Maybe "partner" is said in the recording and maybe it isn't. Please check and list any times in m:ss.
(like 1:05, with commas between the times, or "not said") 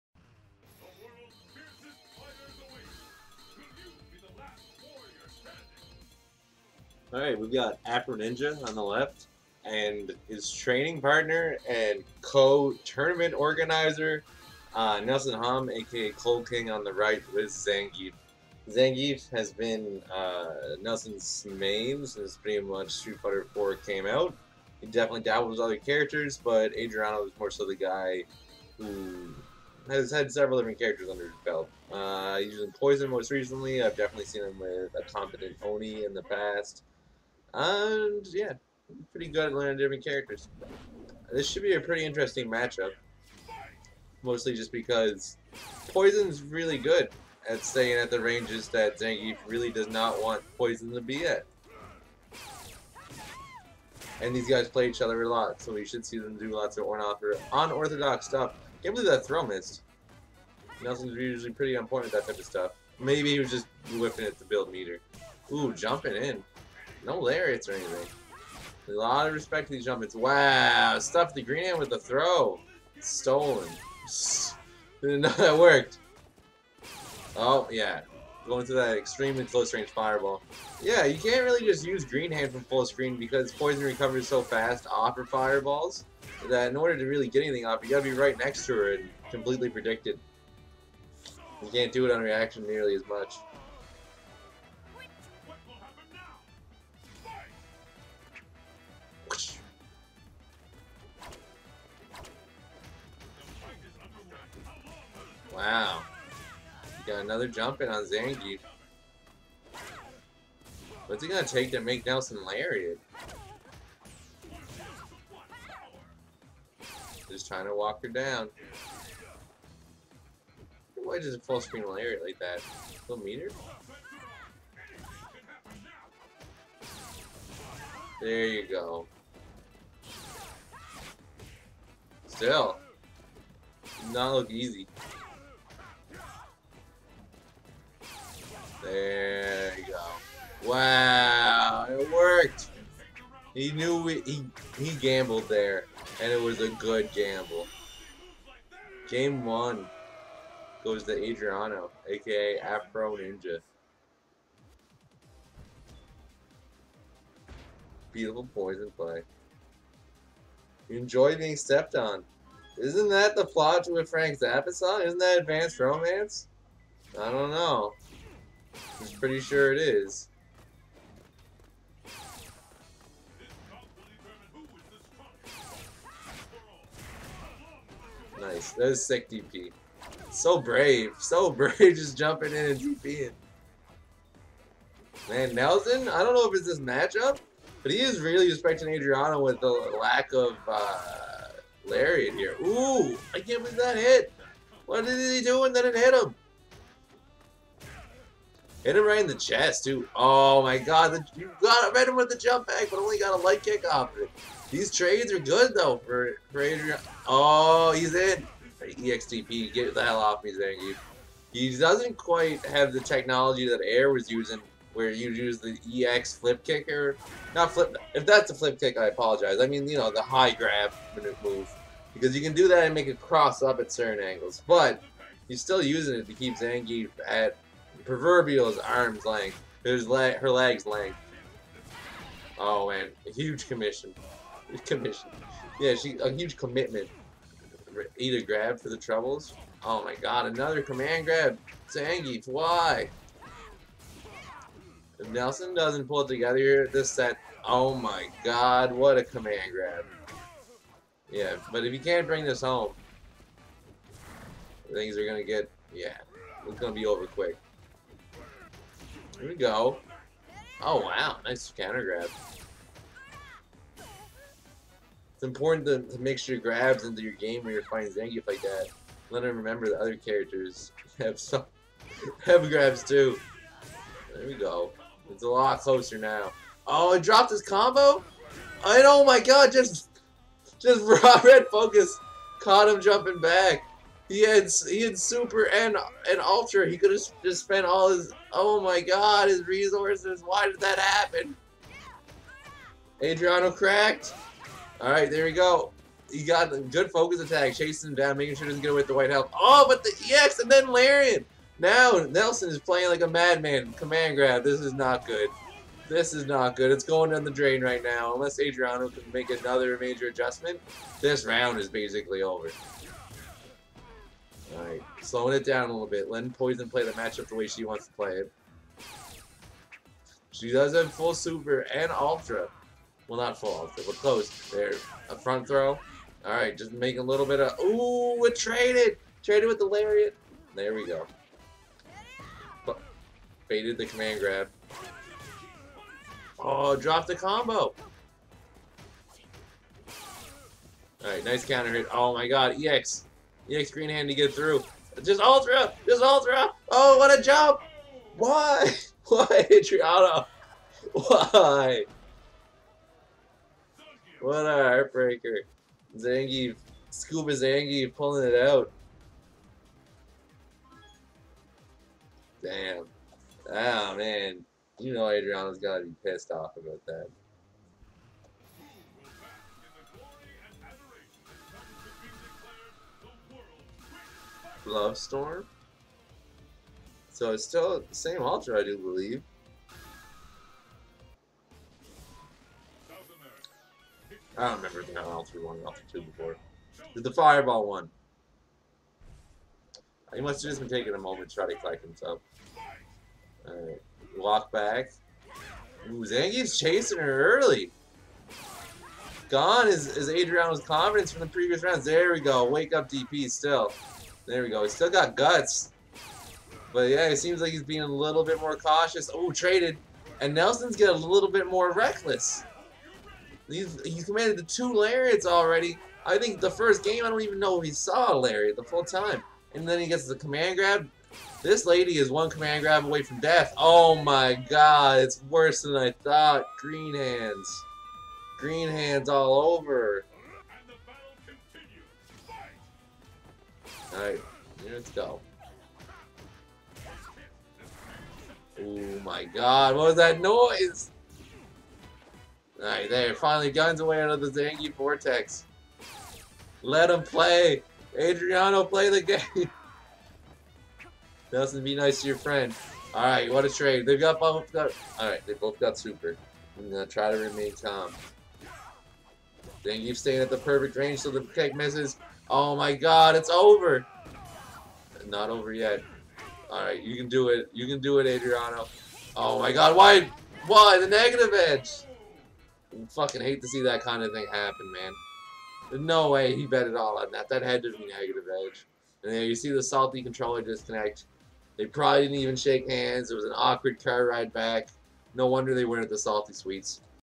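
0:11.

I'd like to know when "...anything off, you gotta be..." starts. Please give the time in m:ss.
1:27.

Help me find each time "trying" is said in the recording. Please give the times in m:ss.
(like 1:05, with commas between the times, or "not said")
1:57.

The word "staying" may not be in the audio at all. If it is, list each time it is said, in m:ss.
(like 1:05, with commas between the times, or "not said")
0:47, 7:40.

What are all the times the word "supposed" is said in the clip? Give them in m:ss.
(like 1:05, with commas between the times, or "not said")
not said.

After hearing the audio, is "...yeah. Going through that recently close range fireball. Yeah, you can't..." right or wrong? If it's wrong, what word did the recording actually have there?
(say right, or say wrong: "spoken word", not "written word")
wrong: "extremely", not "recently".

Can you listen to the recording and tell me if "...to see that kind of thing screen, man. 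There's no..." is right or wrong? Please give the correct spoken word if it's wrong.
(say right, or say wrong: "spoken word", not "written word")
wrong: "happen", not "screen".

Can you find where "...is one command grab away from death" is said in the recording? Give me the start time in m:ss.
7:02.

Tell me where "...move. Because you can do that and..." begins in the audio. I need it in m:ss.
3:41.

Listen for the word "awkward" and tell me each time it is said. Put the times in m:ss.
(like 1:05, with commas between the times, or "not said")
8:03.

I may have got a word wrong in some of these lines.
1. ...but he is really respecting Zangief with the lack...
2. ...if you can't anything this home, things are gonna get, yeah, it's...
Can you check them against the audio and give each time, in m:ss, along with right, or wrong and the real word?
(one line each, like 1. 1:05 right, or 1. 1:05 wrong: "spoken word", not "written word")
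1. 3:07 wrong: "Adriano", not "Zangief"
2. 4:11 wrong: "bring", not "anything".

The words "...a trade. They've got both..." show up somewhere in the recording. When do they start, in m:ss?
7:33.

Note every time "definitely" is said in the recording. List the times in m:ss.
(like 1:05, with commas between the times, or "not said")
0:24, 0:33.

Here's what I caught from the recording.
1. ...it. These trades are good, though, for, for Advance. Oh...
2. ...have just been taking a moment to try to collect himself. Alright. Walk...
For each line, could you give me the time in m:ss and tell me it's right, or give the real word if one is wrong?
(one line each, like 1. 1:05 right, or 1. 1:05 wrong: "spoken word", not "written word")
1. 3:24 wrong: "Adrian", not "Advance"
2. 6:30 right.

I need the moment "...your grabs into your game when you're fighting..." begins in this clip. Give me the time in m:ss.
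4:26.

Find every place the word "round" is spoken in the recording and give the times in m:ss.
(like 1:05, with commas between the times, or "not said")
5:11, 6:41.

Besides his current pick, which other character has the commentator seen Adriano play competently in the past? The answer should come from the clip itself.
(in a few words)
Oni.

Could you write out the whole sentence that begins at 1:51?
What's it gonna take to make Nelson Lariat?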